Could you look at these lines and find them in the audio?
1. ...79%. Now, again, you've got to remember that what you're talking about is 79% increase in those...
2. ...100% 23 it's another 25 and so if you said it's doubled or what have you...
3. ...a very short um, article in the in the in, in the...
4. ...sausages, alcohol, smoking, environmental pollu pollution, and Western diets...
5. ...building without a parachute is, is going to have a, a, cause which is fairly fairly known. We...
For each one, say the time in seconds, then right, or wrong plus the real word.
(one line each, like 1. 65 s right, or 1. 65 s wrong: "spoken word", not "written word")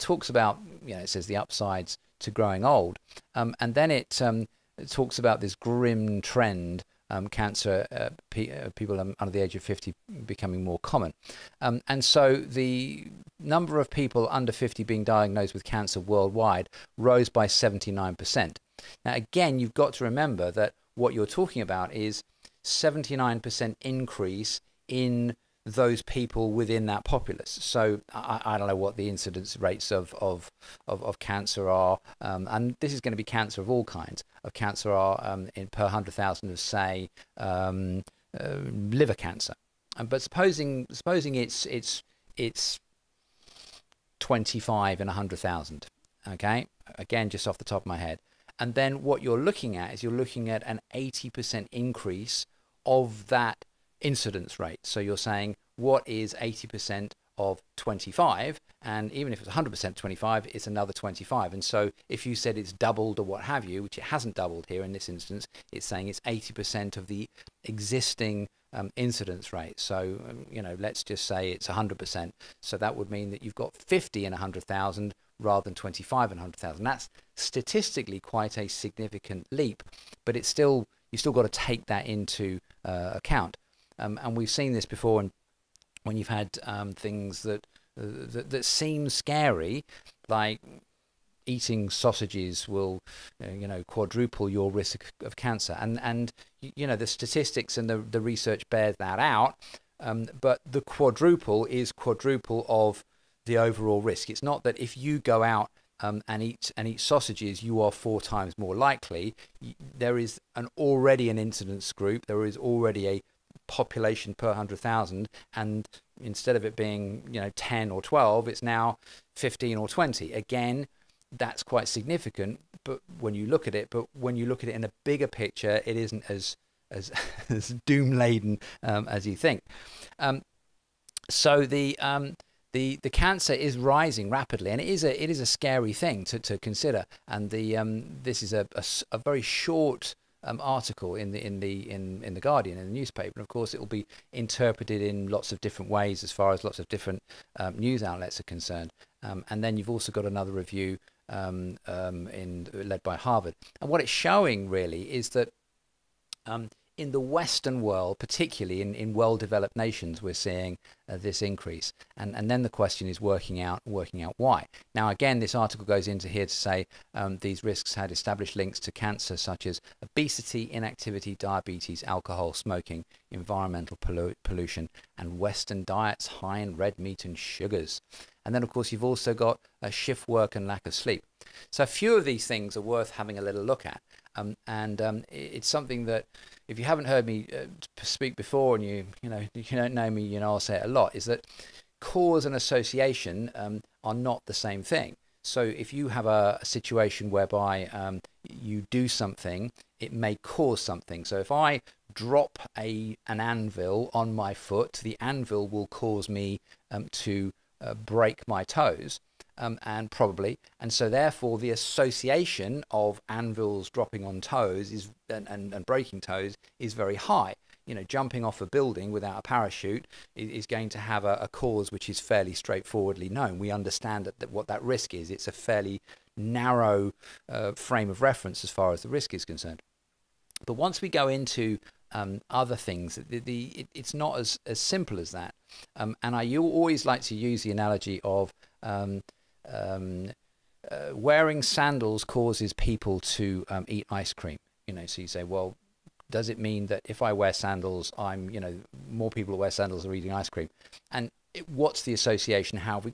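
1. 17 s right
2. 59 s wrong: "25", not "23"
3. 139 s right
4. 171 s wrong: "diabetes", not "sausages"
5. 218 s wrong: "straightforwardly", not "fairly".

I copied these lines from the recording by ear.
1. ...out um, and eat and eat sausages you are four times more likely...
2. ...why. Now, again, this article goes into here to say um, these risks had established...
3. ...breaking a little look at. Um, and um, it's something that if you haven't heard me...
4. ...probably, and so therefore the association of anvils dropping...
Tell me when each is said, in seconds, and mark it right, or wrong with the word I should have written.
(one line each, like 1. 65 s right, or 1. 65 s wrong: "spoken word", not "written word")
1. 105 s right
2. 164 s right
3. 183 s wrong: "having", not "breaking"
4. 210 s right.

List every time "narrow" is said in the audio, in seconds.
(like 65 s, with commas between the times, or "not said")
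226 s.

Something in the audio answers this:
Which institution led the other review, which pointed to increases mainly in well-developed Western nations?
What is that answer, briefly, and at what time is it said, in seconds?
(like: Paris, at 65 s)
Harvard, at 153 s.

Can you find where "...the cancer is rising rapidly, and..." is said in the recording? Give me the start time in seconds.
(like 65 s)
133 s.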